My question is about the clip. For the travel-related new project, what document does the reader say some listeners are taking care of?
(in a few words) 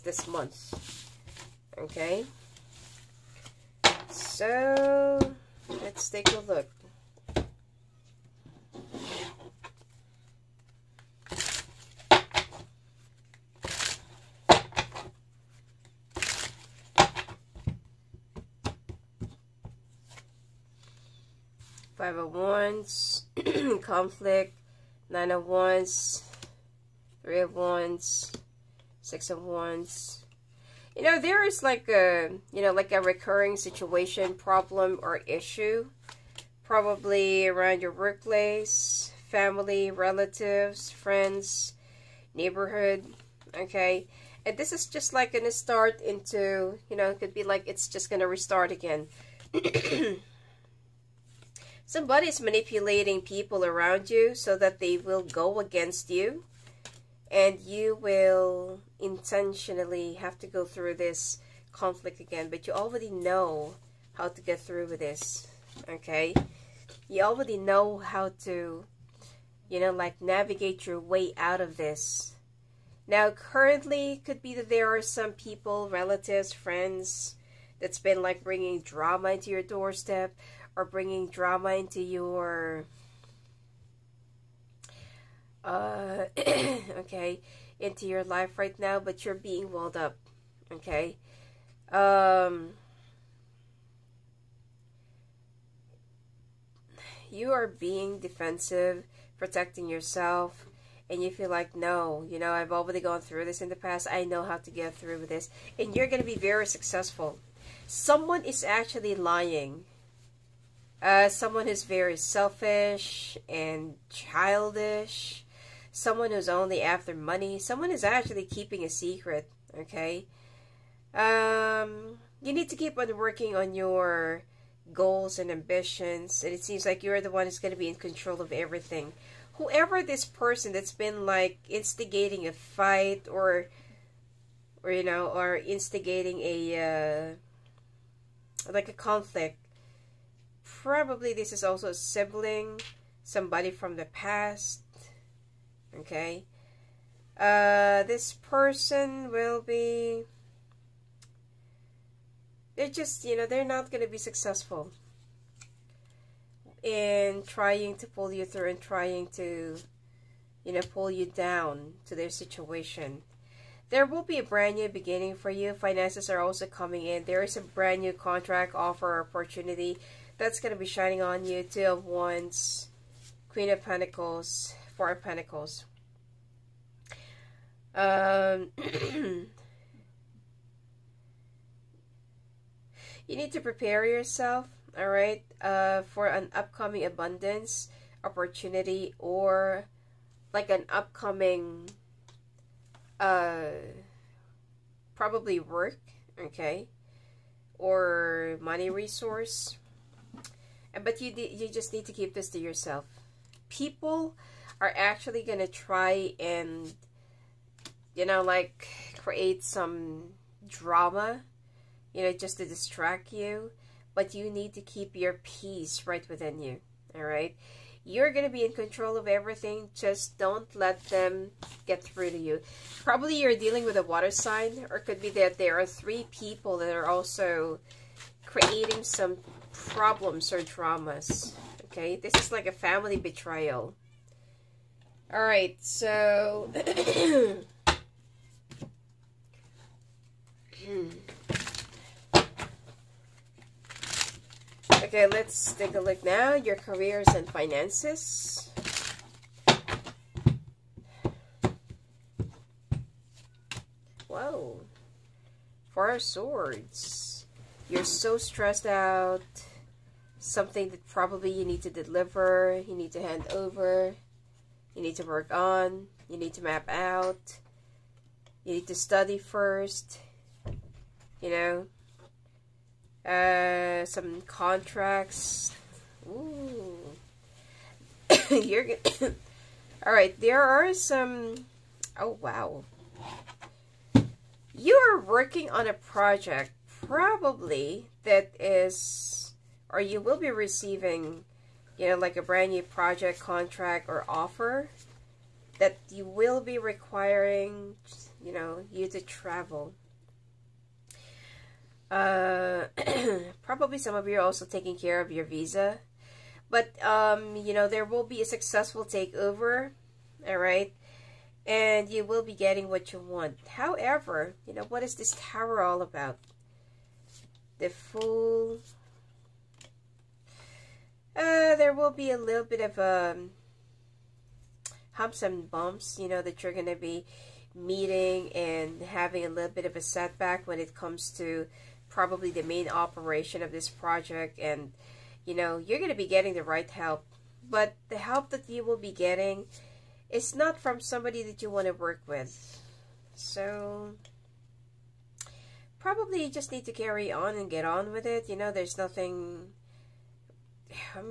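Visa.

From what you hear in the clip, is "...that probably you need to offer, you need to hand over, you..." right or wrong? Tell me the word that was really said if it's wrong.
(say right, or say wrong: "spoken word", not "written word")
wrong: "deliver", not "offer".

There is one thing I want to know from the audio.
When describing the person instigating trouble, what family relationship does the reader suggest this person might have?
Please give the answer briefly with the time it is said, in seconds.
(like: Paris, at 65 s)
Sibling, at 141 s.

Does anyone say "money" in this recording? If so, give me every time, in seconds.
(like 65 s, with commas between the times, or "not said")
117 s, 198 s.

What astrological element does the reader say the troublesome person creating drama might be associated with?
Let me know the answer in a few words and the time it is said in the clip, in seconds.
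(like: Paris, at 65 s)
Water sign, at 224 s.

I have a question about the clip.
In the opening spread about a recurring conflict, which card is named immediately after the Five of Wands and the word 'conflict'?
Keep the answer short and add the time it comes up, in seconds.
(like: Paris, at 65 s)
Nine of Wands, at 25 s.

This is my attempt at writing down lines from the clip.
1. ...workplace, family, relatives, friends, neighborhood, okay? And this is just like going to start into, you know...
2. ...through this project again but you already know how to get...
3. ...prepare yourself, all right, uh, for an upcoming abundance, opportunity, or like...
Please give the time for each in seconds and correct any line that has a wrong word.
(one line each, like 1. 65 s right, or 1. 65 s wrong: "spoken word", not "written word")
1. 37 s right
2. 60 s wrong: "conflict", not "project"
3. 183 s right.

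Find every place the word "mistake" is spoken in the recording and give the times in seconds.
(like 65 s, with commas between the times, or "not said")
not said.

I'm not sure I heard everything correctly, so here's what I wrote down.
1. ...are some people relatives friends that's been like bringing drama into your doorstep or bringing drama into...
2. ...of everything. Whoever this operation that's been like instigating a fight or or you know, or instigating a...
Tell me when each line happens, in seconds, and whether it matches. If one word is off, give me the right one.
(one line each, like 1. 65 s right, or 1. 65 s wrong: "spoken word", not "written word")
1. 74 s right
2. 128 s wrong: "person", not "operation".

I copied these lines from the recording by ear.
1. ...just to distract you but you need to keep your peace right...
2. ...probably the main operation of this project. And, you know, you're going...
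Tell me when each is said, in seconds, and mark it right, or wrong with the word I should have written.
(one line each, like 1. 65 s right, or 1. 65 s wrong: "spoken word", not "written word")
1. 212 s right
2. 332 s right.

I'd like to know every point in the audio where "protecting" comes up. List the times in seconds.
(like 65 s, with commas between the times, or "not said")
99 s.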